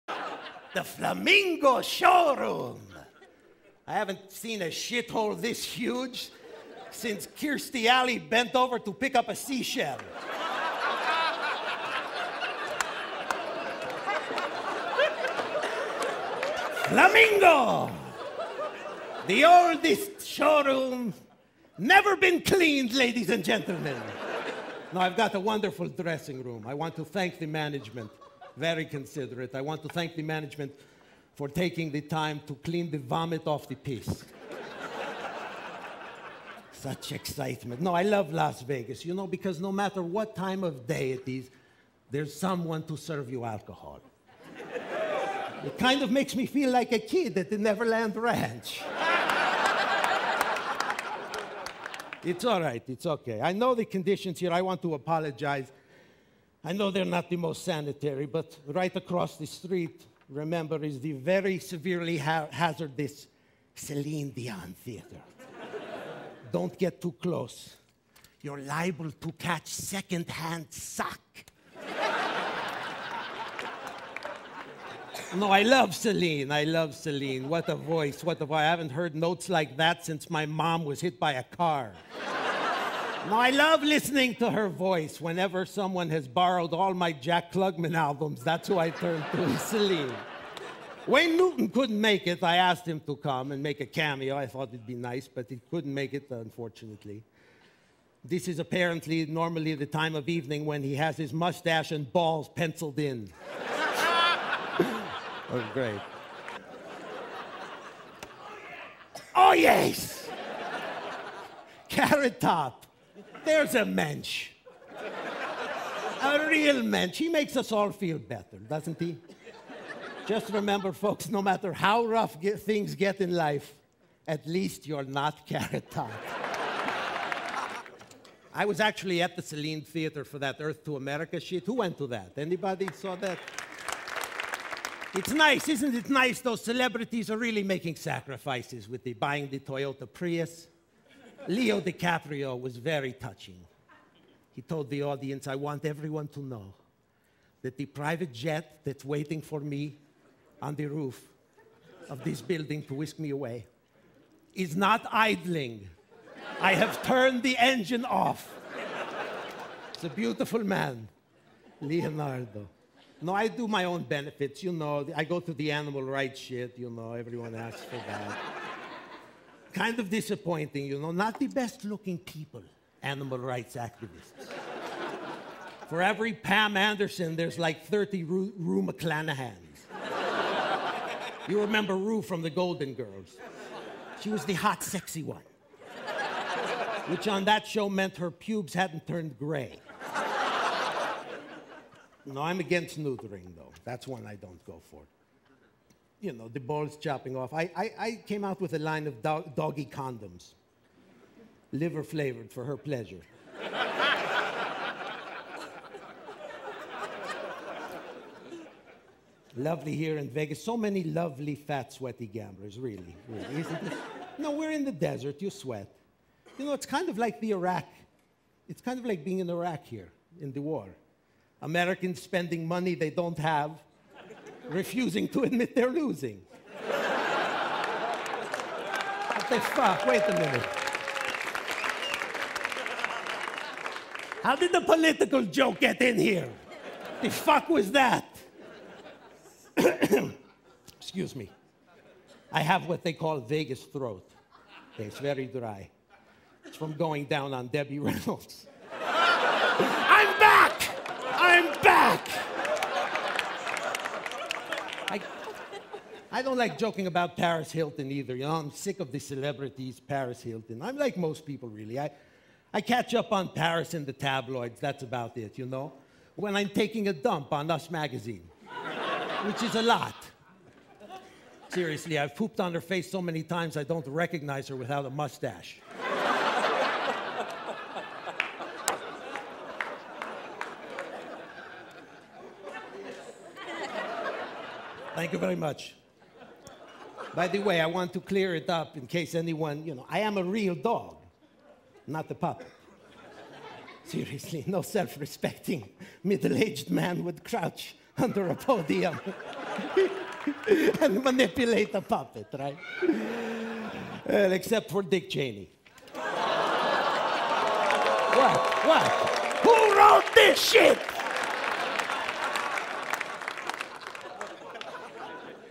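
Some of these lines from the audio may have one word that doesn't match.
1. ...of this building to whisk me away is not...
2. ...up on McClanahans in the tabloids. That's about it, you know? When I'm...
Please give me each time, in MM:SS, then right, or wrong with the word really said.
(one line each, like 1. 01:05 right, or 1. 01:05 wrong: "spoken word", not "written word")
1. 02:32 right
2. 04:23 wrong: "Paris", not "McClanahans".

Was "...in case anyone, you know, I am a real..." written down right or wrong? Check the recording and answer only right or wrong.
right.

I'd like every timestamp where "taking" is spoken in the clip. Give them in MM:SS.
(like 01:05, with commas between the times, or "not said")
00:31, 04:26.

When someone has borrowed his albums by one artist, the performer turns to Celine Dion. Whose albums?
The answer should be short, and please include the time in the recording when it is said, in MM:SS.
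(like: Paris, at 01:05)
Jack Klugman, at 01:27.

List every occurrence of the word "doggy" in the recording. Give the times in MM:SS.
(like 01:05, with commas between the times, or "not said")
03:19.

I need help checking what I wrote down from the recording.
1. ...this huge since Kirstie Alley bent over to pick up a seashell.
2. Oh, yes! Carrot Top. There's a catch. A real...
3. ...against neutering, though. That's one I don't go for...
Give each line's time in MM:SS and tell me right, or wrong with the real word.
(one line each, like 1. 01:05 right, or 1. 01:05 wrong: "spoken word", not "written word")
1. 00:05 right
2. 01:49 wrong: "mensch", not "catch"
3. 03:12 right.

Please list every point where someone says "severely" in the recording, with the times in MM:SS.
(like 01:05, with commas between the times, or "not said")
01:01.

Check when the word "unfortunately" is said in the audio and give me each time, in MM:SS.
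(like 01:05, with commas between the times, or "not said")
01:36.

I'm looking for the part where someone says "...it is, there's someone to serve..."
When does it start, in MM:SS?
00:41.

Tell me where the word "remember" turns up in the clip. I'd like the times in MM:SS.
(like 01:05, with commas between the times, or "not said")
01:00, 02:00, 03:01.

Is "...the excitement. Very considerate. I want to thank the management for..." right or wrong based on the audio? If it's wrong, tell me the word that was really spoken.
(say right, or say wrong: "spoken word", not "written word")
wrong: "management", not "excitement".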